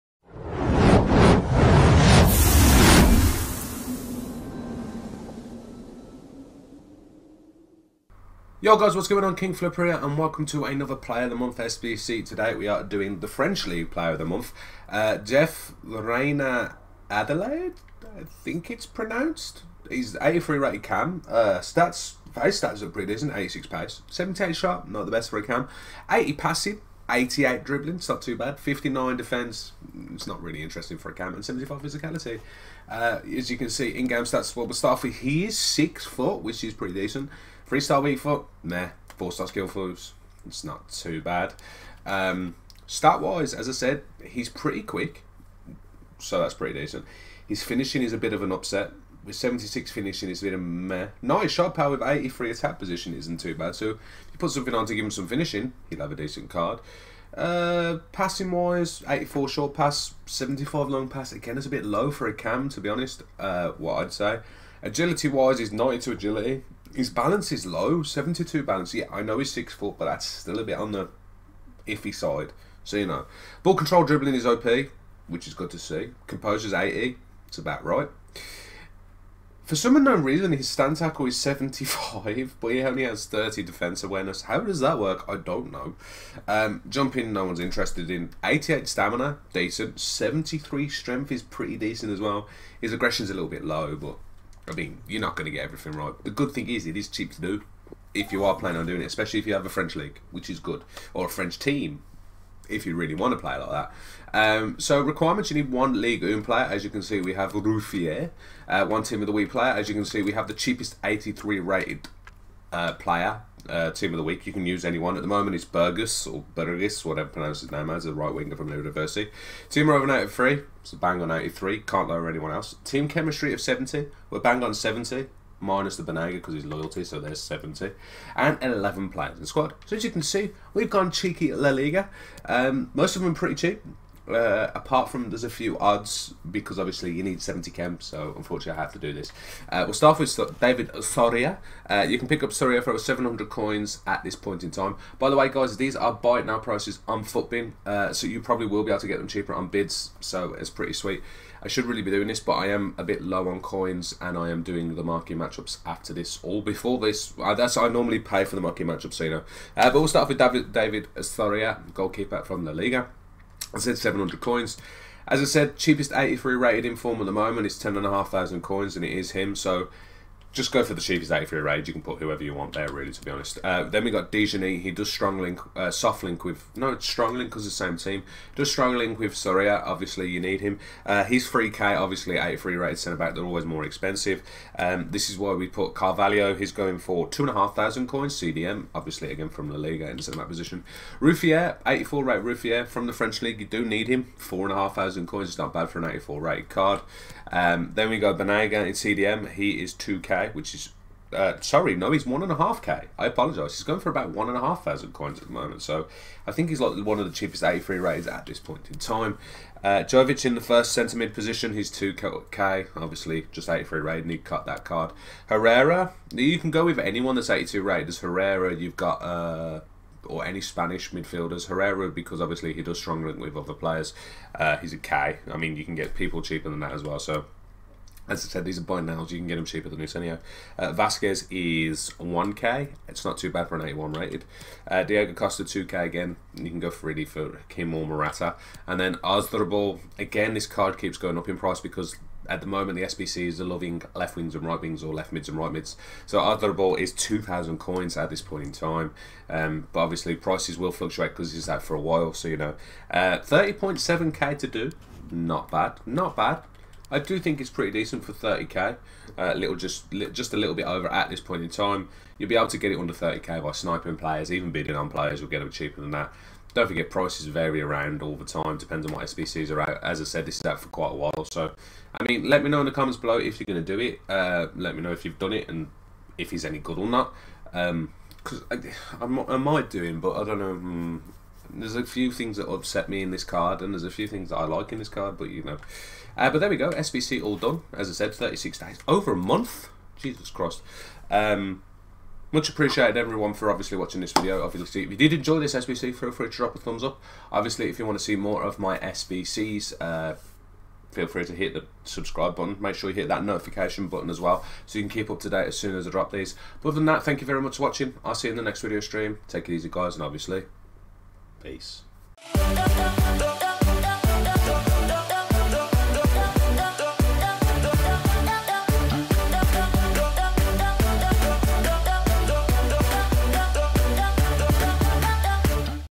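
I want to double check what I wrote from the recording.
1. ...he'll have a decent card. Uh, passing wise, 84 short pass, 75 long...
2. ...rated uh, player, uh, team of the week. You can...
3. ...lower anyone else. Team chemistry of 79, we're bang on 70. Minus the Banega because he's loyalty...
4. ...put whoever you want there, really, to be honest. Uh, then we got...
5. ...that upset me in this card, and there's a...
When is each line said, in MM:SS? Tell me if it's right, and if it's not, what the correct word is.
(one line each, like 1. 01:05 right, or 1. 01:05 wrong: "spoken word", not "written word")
1. 00:55 right
2. 01:51 right
3. 02:02 wrong: "70", not "79"
4. 02:52 right
5. 04:42 right.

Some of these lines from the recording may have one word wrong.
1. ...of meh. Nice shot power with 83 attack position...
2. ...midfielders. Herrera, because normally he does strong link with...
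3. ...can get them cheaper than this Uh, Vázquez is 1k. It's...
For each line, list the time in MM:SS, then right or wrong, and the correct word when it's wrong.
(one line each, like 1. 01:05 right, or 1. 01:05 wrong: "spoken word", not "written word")
1. 00:50 right
2. 03:41 wrong: "obviously", not "normally"
3. 03:49 right.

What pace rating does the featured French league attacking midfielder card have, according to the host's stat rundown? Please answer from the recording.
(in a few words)
86.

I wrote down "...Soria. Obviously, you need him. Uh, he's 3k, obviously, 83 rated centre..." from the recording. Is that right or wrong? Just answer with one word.
right.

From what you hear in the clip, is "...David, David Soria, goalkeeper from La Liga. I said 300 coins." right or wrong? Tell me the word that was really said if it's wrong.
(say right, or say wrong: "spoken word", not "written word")
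wrong: "700", not "300".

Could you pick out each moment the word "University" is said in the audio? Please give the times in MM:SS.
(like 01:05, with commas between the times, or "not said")
01:58.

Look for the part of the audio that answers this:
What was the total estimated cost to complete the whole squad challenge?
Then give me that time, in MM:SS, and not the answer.
04:13.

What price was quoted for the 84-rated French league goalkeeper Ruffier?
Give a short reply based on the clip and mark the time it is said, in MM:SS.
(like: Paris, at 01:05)
4,500 coins, at 03:14.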